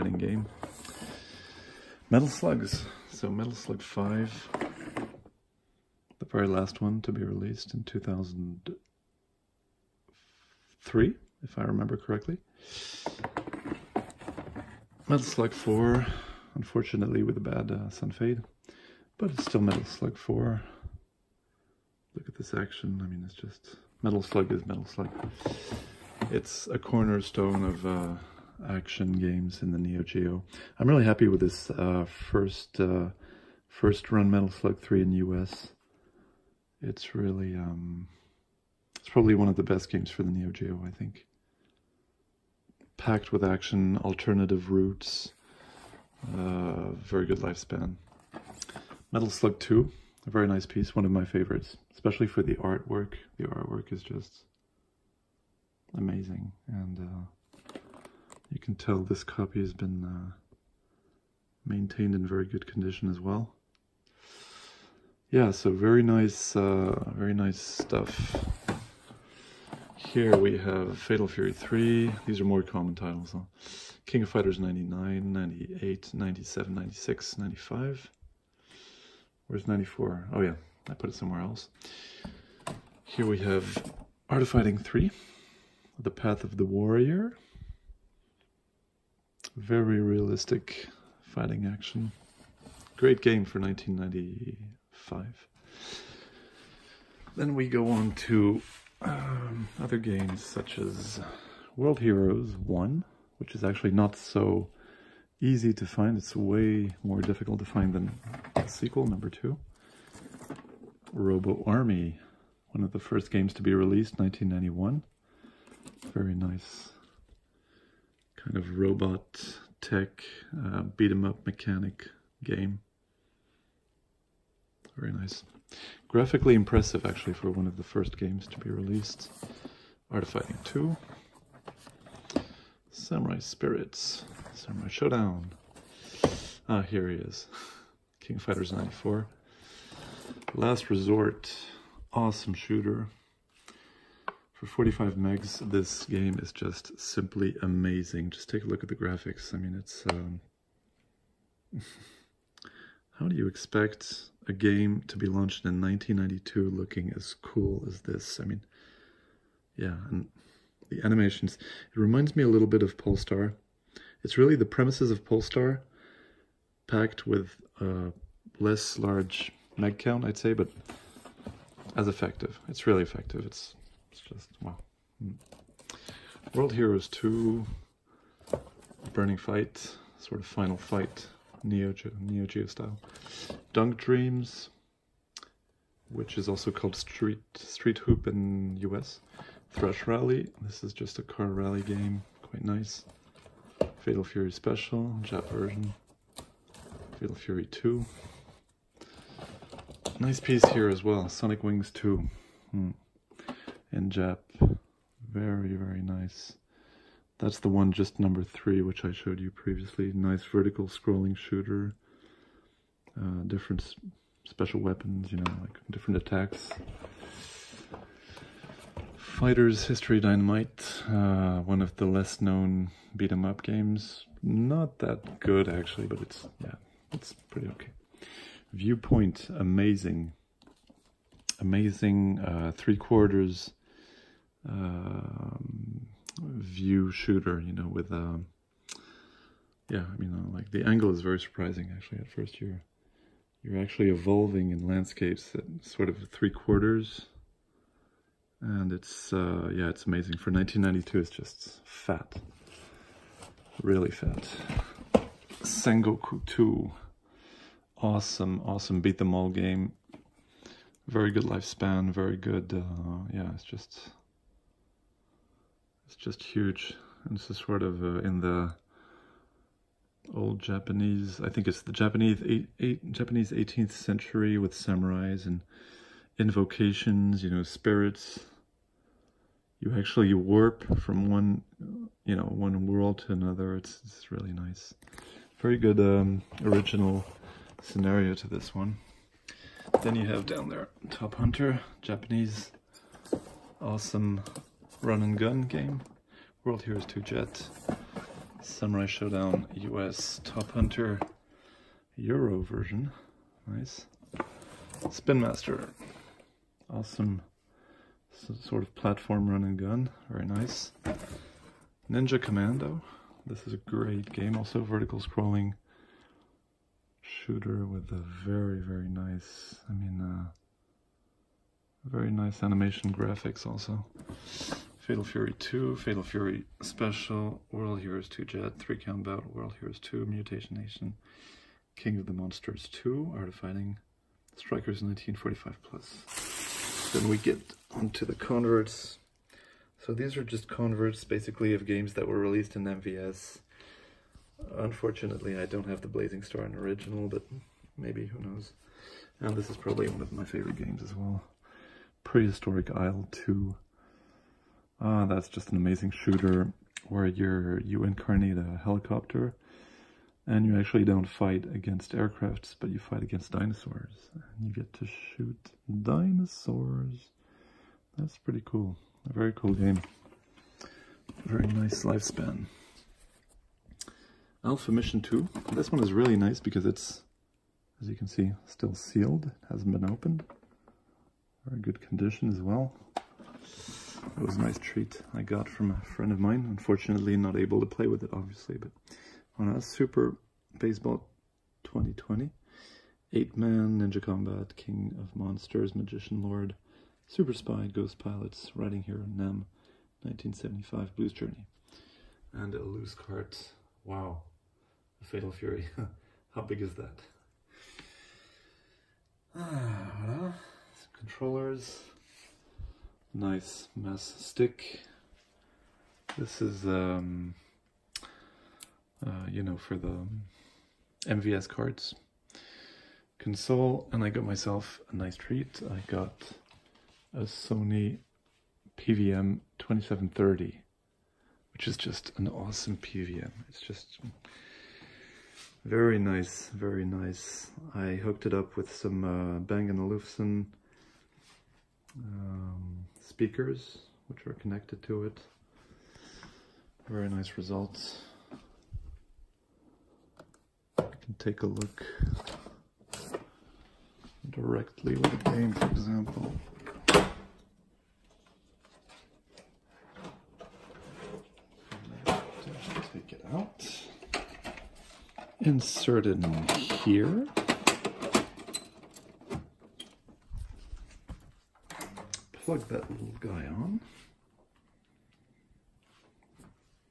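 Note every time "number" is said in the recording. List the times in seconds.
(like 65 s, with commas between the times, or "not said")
109 s, 208 s.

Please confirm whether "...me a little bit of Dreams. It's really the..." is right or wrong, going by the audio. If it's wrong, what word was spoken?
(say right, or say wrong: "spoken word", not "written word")
wrong: "Pulstar", not "Dreams".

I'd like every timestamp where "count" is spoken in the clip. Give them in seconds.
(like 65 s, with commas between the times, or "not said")
169 s, 328 s.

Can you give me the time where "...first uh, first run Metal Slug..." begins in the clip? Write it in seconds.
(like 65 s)
32 s.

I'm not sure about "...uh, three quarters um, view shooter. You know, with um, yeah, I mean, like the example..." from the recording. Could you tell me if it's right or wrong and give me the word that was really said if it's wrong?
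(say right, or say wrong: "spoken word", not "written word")
wrong: "angle", not "example".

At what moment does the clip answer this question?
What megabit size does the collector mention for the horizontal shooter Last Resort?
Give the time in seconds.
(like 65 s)
144 s.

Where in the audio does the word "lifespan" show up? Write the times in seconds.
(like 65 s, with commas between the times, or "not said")
47 s, 261 s, 372 s.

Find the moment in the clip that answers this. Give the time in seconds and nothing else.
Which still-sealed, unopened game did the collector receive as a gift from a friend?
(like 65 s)
374 s.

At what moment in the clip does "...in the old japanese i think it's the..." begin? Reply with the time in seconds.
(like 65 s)
268 s.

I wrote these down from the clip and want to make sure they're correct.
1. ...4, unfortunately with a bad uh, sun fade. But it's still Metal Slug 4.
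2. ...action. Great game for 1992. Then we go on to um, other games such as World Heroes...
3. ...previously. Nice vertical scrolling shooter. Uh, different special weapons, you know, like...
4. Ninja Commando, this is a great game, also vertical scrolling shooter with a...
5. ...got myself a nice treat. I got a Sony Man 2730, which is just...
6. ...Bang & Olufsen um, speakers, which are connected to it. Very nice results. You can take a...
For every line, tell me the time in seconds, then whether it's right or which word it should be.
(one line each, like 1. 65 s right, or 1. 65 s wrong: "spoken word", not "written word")
1. 15 s right
2. 91 s wrong: "1995", not "1992"
3. 209 s right
4. 312 s right
5. 424 s wrong: "PVM", not "Man"
6. 439 s right.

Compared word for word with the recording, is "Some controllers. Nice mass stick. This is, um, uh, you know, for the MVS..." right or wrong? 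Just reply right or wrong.
right.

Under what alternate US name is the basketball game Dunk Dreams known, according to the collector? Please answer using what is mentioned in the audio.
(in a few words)
Street Hoop.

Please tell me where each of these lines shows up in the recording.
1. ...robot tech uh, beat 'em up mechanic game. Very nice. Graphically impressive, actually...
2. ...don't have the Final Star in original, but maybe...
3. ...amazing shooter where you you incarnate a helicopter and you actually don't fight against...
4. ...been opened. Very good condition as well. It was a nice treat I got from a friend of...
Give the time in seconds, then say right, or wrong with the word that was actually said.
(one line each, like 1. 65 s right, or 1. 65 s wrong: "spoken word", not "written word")
1. 118 s right
2. 345 s wrong: "Blazing", not "Final"
3. 355 s right
4. 379 s right.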